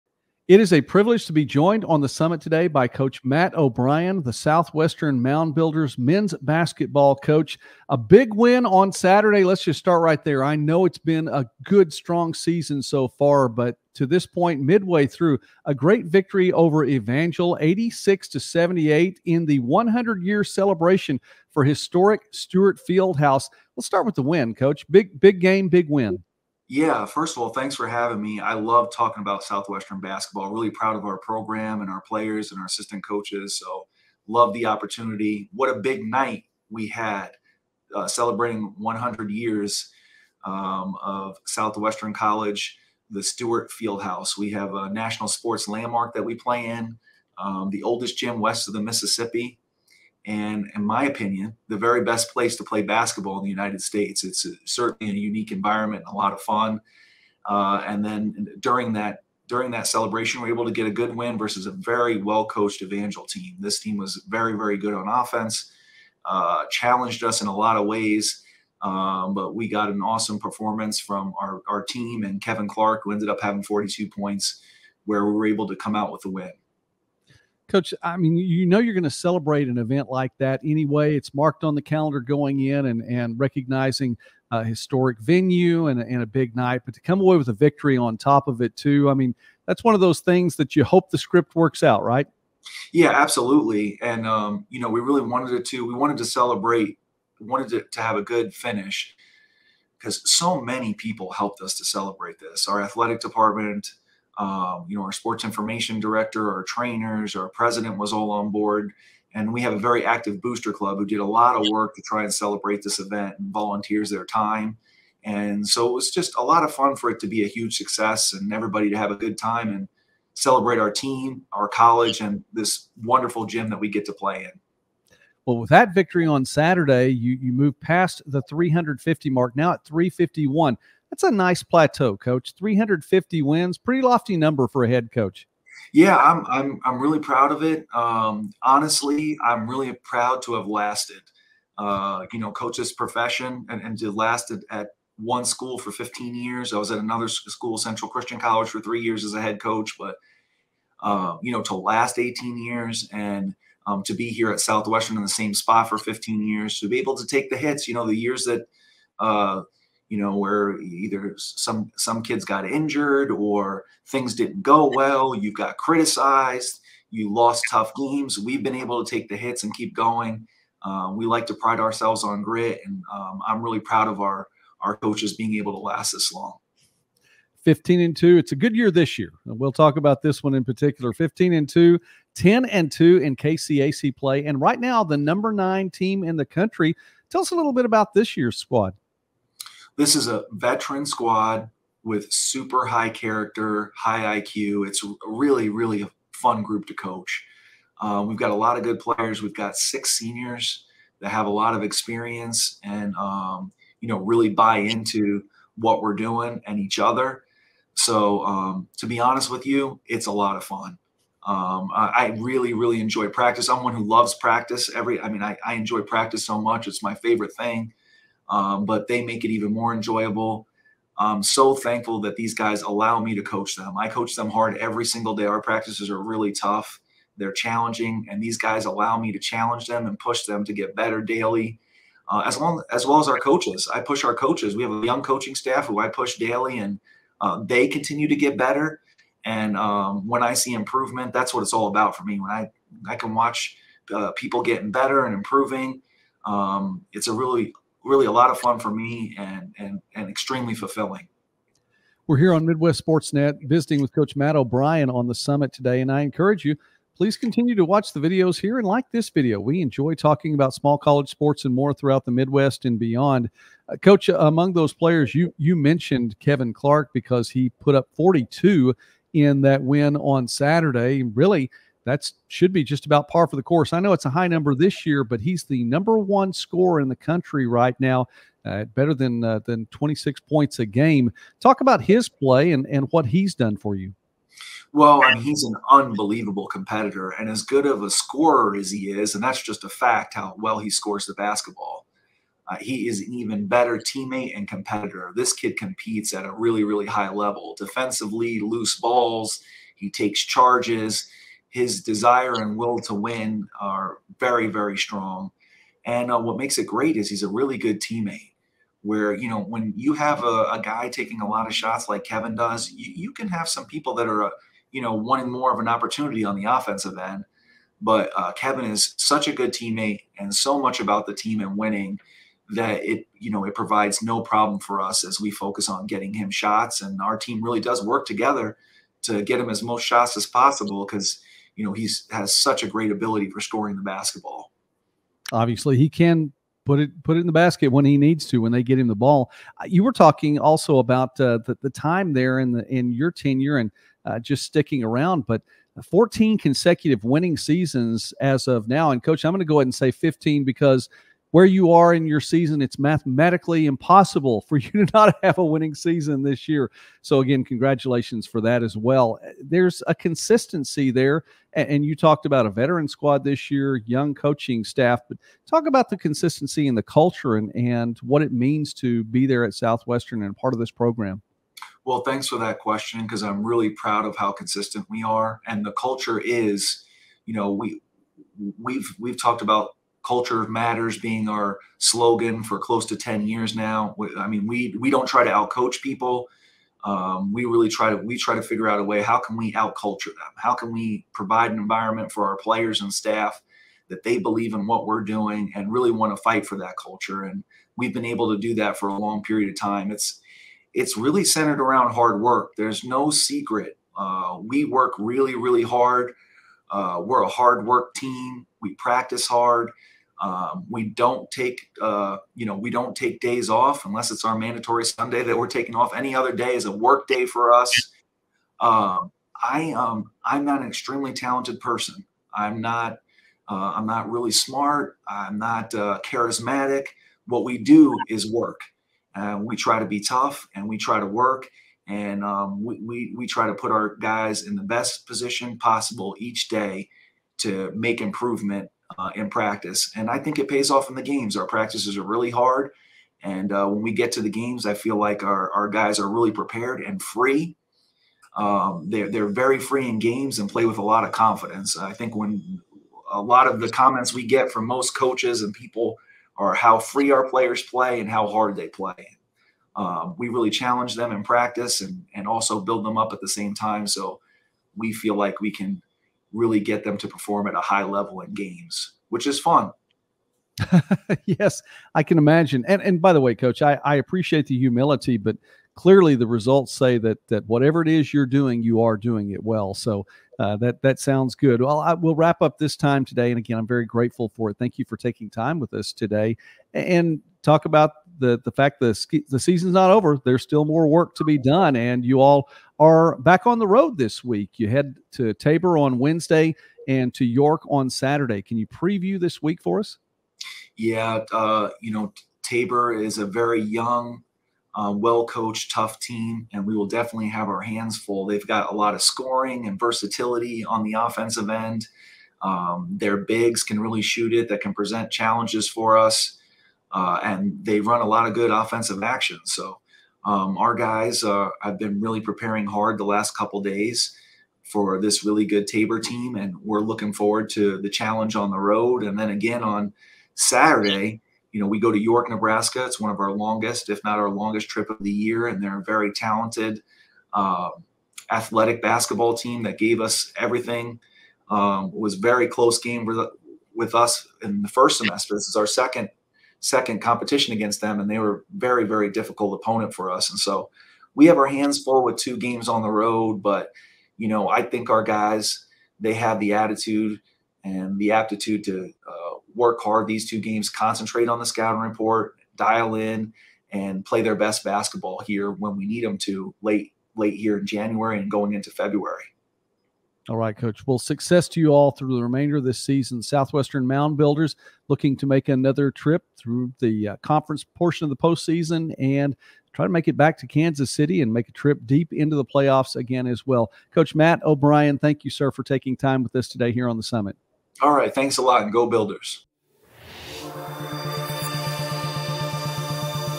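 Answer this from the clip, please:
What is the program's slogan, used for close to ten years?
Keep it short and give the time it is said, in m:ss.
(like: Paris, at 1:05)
Culture matters, at 6:20.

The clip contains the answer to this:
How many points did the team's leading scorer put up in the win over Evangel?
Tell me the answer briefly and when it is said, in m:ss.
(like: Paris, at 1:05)
42, at 1:13.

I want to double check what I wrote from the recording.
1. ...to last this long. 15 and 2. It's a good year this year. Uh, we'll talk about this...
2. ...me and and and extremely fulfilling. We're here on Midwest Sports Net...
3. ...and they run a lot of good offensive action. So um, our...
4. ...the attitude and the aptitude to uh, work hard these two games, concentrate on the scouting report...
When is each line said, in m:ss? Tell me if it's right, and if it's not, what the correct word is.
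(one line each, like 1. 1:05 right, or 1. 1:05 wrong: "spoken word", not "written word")
1. 2:55 right
2. 4:08 right
3. 8:37 right
4. 9:16 right.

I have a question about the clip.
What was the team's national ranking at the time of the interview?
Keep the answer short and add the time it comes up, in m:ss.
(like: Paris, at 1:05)
9, at 3:05.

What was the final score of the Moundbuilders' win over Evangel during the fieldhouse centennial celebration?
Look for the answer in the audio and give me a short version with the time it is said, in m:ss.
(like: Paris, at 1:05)
86 to 78, at 0:17.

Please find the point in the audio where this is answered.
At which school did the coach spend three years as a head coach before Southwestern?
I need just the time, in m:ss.
2:27.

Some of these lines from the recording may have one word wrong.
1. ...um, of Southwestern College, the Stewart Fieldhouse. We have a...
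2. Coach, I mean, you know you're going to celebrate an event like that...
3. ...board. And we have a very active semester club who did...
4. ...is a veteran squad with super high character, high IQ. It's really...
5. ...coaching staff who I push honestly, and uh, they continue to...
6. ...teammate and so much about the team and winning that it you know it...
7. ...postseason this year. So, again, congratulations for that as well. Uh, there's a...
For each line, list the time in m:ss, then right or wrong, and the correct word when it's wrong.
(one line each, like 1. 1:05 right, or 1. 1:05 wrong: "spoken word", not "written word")
1. 0:40 right
2. 1:17 right
3. 1:48 wrong: "booster", not "semester"
4. 3:10 right
5. 3:55 wrong: "daily", not "honestly"
6. 5:19 right
7. 5:55 wrong: "season", not "postseason".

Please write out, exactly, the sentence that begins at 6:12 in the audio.
Well, thanks for that question because I'm really proud of how consistent we are.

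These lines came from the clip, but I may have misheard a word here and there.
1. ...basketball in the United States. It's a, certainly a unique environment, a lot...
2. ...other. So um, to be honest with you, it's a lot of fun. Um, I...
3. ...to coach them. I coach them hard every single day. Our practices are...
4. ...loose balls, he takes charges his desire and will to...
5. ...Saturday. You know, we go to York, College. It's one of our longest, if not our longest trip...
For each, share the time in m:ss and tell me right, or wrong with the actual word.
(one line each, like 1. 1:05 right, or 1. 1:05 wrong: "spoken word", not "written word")
1. 0:52 right
2. 3:26 right
3. 3:43 right
4. 4:58 right
5. 8:50 wrong: "Nebraska", not "College".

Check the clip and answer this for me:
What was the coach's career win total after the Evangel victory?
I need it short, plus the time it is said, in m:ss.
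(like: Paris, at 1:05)
351, at 2:09.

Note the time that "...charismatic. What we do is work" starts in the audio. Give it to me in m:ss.
7:06.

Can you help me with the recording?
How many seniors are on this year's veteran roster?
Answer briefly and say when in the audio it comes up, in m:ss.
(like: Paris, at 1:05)
6, at 3:19.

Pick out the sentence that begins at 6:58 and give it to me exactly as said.
Um, I um, I'm not an extremely talented person.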